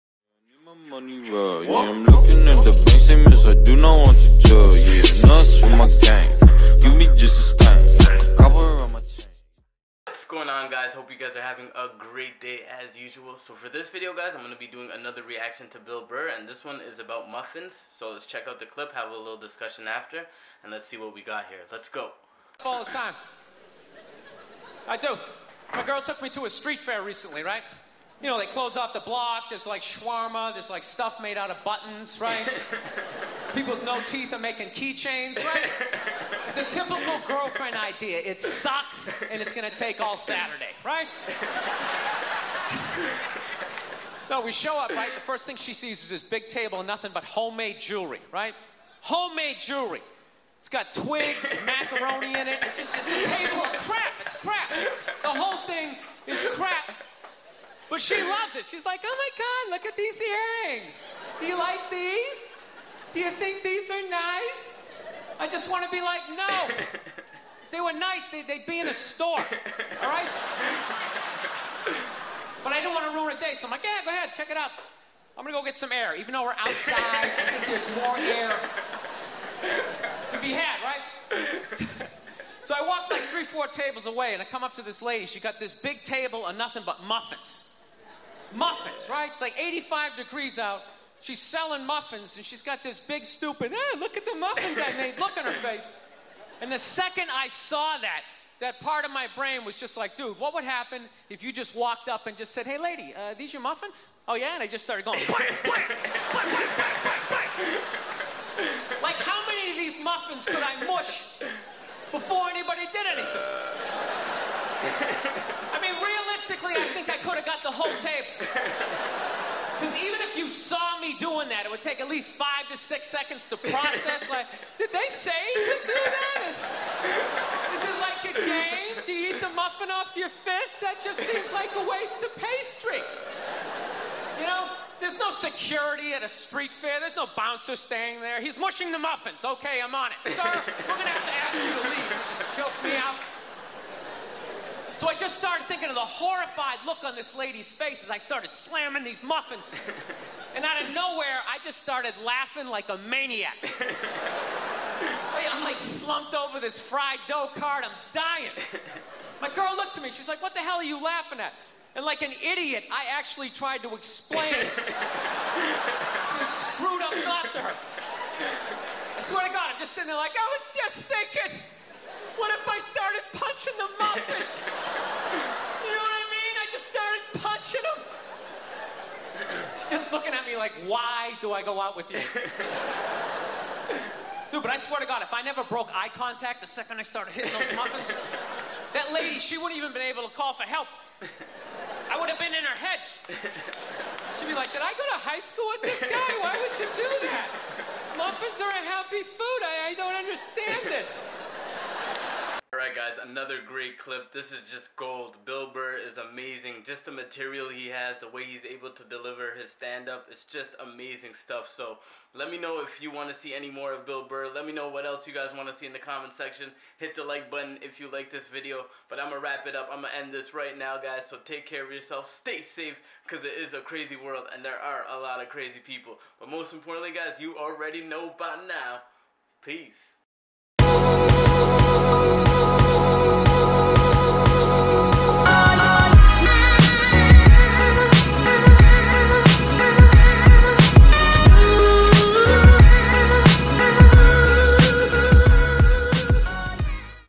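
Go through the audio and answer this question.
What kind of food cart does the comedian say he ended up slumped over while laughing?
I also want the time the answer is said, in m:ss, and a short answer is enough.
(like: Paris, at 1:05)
Fried dough cart, at 2:36.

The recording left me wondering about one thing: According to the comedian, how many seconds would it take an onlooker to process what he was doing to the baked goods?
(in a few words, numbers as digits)
5 to 6 seconds.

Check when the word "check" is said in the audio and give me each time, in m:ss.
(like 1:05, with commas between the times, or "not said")
0:18, 1:14.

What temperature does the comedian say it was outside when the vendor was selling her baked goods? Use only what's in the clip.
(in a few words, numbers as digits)
85 degrees.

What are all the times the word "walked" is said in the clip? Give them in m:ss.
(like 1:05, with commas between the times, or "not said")
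1:22, 1:41.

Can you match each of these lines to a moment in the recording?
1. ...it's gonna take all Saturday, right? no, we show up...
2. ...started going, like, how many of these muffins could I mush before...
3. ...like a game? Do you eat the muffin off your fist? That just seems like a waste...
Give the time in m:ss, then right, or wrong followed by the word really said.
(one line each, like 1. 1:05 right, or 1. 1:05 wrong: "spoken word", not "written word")
1. 0:39 right
2. 1:44 right
3. 2:08 right.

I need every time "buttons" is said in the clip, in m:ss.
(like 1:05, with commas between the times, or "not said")
0:31, 3:37.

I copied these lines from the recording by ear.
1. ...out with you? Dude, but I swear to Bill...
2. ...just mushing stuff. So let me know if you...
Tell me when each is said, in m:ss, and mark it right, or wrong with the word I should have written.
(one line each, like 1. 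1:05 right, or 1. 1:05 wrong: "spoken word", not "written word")
1. 3:01 wrong: "God", not "Bill"
2. 3:30 wrong: "amazing", not "mushing".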